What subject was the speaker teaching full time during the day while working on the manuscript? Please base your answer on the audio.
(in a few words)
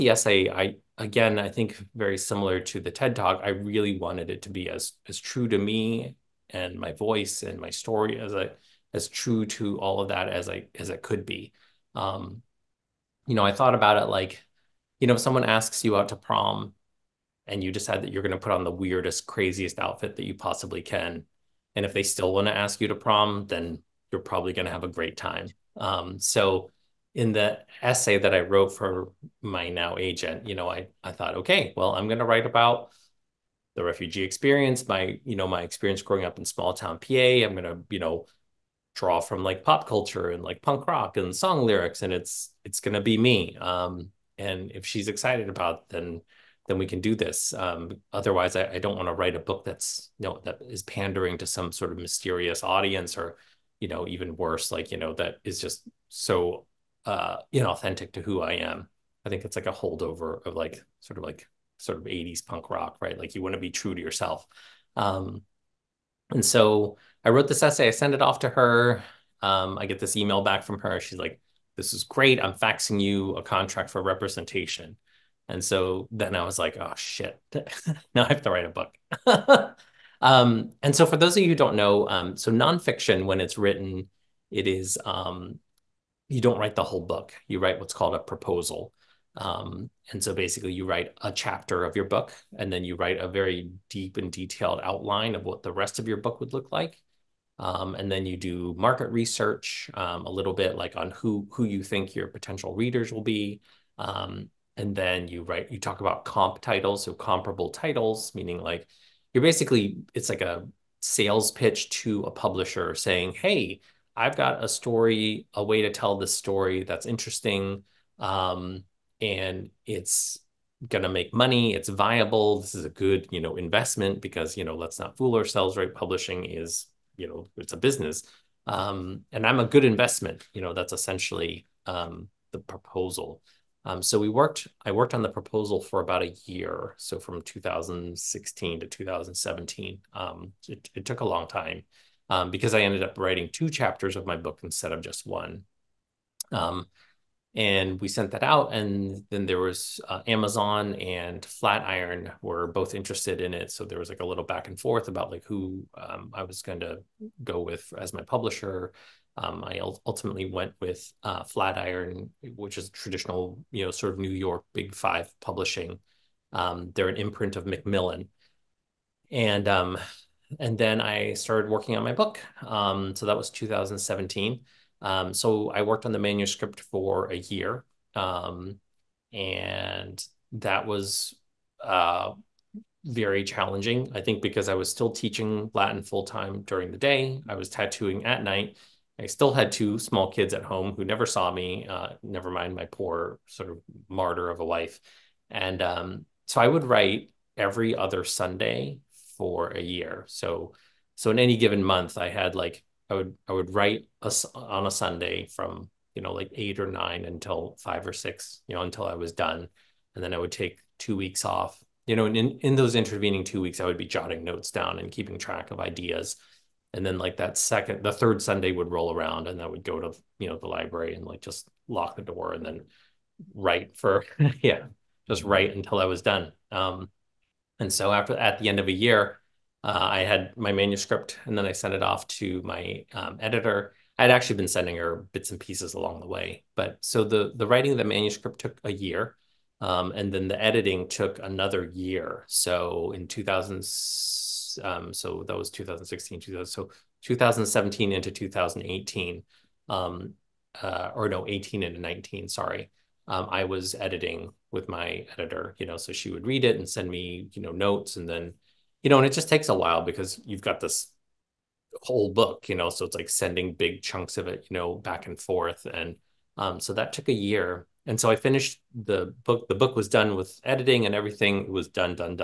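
Latin.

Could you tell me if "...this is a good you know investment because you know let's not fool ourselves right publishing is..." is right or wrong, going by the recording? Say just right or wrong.
right.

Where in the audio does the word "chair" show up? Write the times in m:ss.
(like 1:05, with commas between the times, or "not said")
not said.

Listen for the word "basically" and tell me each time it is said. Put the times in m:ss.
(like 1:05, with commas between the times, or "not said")
1:30, 1:49.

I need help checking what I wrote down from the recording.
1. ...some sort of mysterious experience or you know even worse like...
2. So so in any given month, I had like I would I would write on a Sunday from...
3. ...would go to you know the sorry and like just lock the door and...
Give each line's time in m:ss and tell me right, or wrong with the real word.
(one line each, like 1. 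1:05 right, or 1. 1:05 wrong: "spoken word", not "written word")
1. 0:51 wrong: "audience", not "experience"
2. 3:20 right
3. 3:39 wrong: "library", not "sorry".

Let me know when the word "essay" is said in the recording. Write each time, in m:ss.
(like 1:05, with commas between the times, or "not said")
0:00, 0:27, 1:07.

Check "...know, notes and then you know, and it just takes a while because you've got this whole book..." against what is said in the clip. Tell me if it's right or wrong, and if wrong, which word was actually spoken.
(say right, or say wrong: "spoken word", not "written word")
right.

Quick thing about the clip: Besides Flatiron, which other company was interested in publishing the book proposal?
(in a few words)
Amazon.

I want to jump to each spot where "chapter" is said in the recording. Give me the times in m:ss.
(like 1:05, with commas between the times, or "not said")
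1:31, 2:23.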